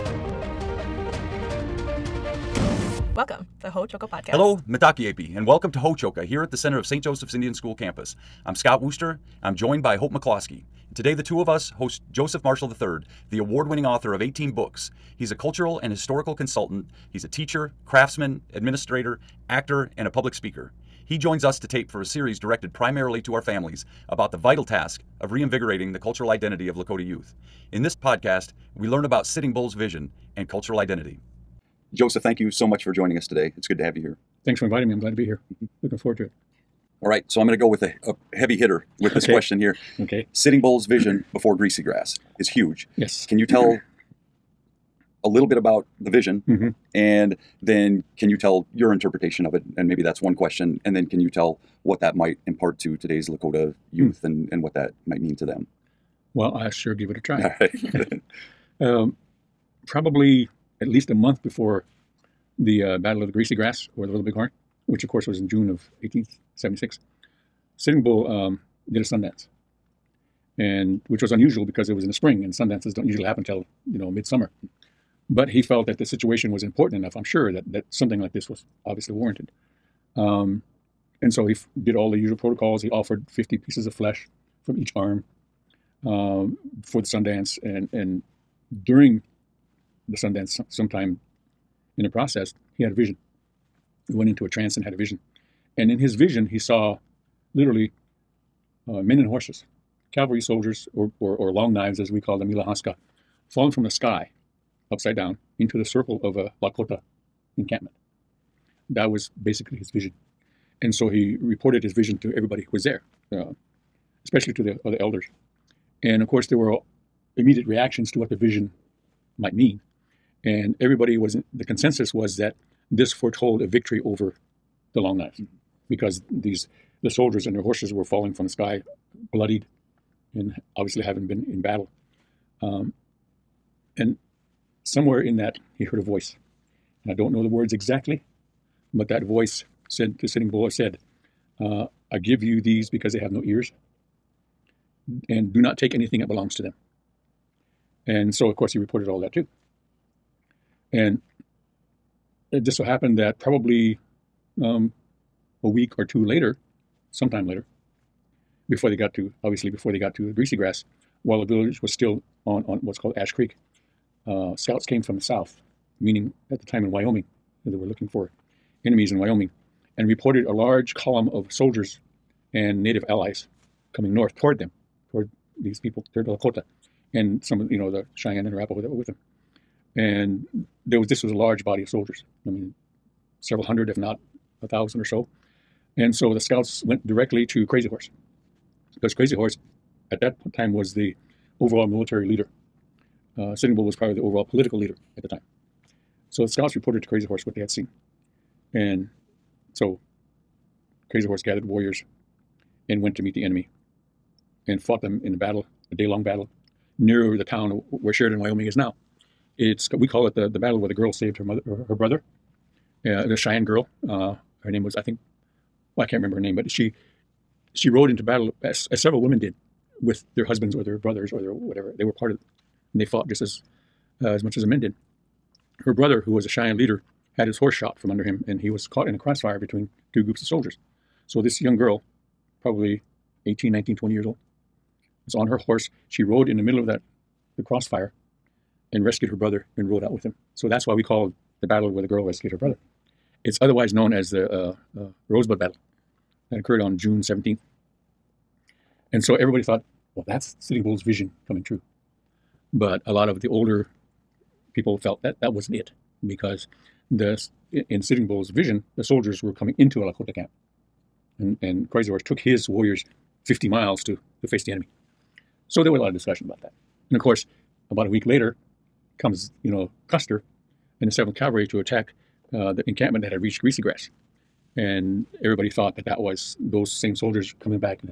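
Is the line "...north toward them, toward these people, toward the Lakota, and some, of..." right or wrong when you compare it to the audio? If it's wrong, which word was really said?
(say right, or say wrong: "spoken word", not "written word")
right.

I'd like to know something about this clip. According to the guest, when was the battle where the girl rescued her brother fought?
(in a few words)
June 17th.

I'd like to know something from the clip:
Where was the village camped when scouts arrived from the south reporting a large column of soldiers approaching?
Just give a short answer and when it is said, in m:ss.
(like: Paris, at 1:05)
Ash Creek, at 2:43.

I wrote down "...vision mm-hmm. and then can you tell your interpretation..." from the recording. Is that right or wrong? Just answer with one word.
right.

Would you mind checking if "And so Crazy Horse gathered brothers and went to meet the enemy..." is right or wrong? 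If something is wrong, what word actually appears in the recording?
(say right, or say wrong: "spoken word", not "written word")
wrong: "warriors", not "brothers".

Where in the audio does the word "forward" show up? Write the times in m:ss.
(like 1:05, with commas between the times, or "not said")
0:35.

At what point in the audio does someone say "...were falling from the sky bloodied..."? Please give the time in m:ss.
2:07.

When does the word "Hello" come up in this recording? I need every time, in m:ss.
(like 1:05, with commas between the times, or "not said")
0:04.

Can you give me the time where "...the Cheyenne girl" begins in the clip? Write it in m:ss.
3:33.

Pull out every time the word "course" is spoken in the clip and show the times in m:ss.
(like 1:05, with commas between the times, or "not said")
1:05, 1:56, 2:28, 4:27.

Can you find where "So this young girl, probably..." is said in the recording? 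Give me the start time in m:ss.
3:51.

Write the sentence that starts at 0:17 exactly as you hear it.
He's a teacher, craftsman, administrator, actor, and a public speaker.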